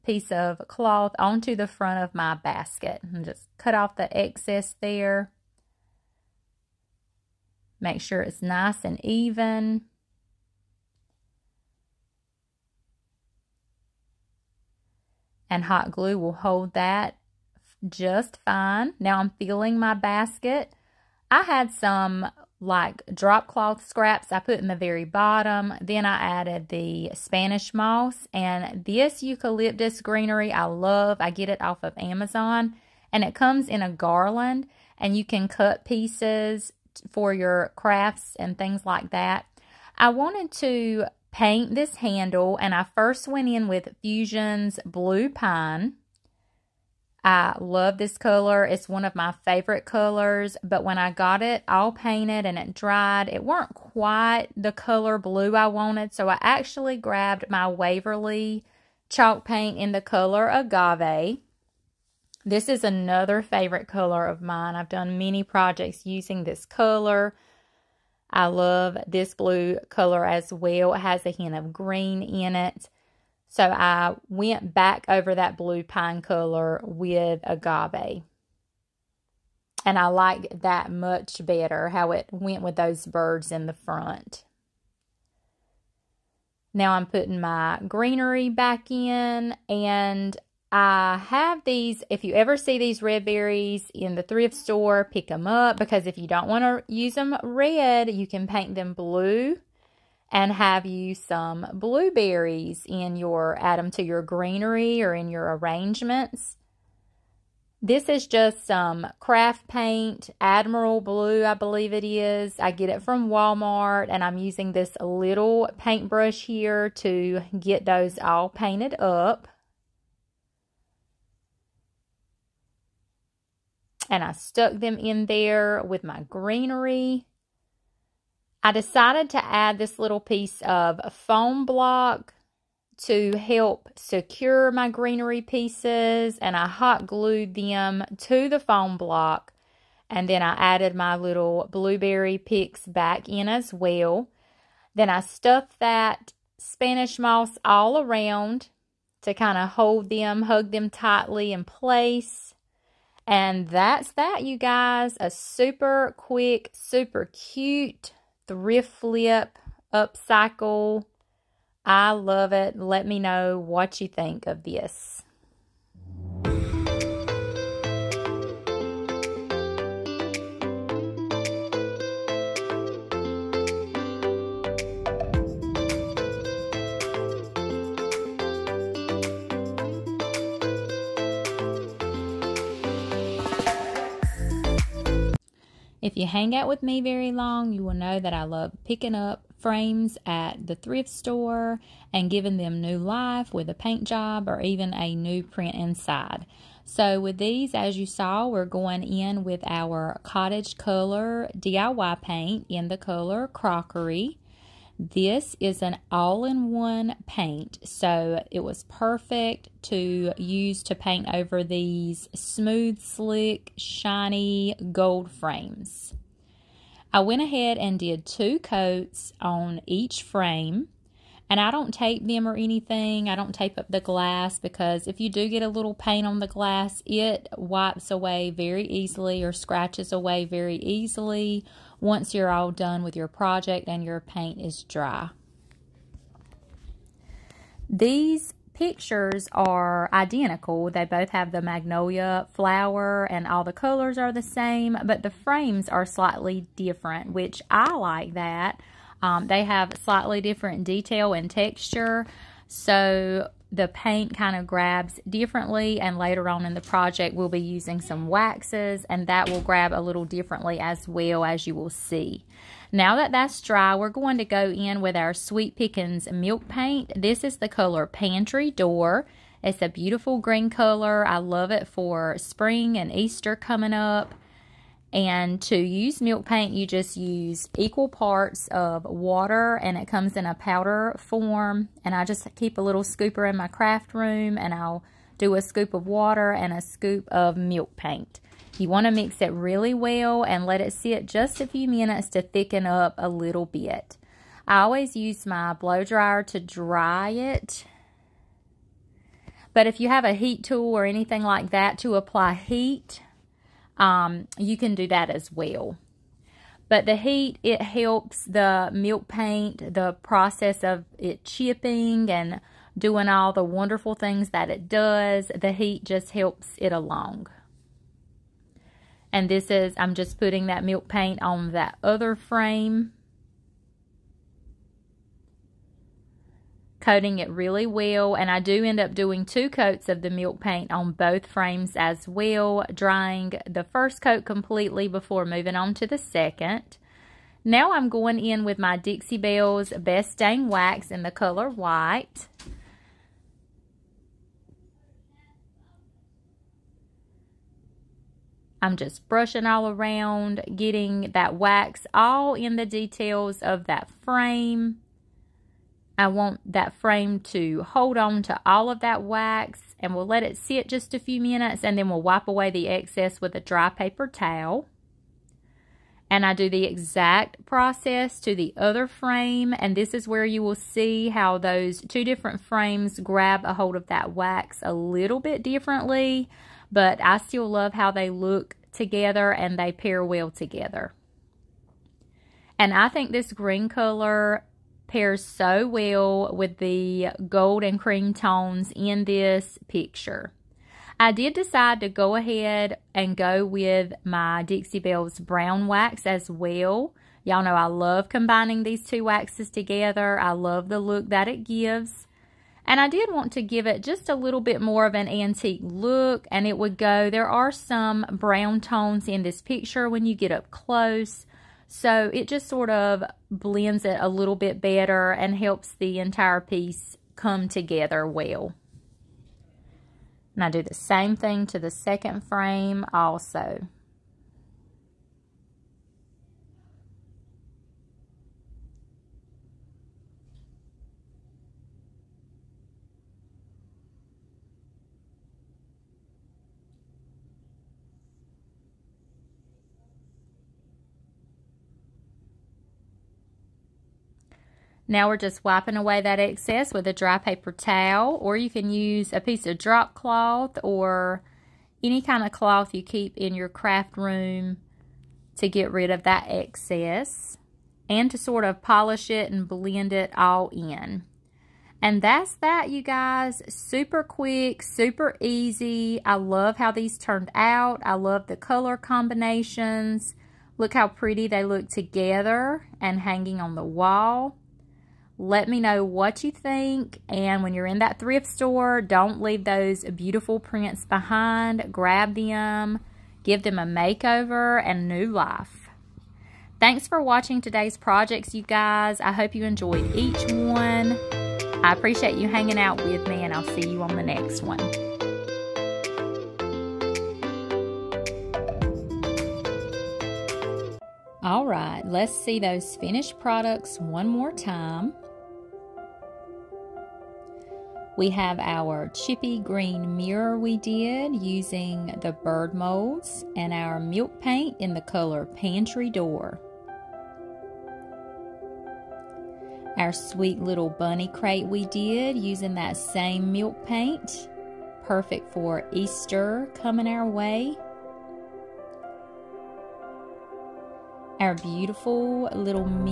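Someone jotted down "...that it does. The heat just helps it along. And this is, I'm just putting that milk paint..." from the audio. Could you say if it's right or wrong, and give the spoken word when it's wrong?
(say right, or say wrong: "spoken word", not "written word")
right.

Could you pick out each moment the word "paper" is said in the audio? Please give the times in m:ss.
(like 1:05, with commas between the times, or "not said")
6:03, 7:27.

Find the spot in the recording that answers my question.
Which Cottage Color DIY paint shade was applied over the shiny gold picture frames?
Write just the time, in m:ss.
3:23.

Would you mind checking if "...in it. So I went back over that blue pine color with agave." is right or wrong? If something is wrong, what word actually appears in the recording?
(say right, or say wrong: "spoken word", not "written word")
right.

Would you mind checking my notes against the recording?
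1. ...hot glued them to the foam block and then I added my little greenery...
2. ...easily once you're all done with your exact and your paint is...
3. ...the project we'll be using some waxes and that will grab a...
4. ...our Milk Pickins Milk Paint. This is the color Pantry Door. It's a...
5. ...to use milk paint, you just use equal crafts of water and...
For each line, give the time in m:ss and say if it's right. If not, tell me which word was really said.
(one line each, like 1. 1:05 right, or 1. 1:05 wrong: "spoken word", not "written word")
1. 2:16 wrong: "blueberry", not "greenery"
2. 3:50 wrong: "project", not "exact"
3. 4:16 right
4. 4:25 wrong: "Sweet", not "Milk"
5. 4:35 wrong: "parts", not "crafts".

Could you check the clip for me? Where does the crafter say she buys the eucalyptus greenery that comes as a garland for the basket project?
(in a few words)
Amazon.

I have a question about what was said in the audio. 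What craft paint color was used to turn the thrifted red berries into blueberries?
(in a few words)
Admiral Blue.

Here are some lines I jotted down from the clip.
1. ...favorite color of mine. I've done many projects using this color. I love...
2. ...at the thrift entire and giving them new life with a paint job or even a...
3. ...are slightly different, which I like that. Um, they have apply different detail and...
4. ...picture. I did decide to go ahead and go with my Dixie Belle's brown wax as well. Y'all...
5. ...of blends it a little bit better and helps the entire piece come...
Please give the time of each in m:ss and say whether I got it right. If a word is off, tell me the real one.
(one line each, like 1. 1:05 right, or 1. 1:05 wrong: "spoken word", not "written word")
1. 1:03 right
2. 3:10 wrong: "store", not "entire"
3. 4:05 wrong: "slightly", not "apply"
4. 6:29 right
5. 6:52 right.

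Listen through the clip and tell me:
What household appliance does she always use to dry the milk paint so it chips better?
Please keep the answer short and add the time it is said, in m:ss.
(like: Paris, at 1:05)
Blow dryer, at 4:55.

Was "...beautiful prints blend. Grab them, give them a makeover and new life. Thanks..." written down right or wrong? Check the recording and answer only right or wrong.
wrong.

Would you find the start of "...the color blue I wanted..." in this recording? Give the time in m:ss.
0:54.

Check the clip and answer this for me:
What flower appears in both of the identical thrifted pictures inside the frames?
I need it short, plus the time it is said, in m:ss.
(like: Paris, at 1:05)
Magnolia, at 4:01.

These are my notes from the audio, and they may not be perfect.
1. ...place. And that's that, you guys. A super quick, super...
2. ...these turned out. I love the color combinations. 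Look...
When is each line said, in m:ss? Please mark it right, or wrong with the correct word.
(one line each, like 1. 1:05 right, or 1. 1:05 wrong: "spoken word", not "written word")
1. 2:31 right
2. 7:46 right.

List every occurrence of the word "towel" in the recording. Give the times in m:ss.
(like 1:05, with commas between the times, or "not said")
6:04, 7:27.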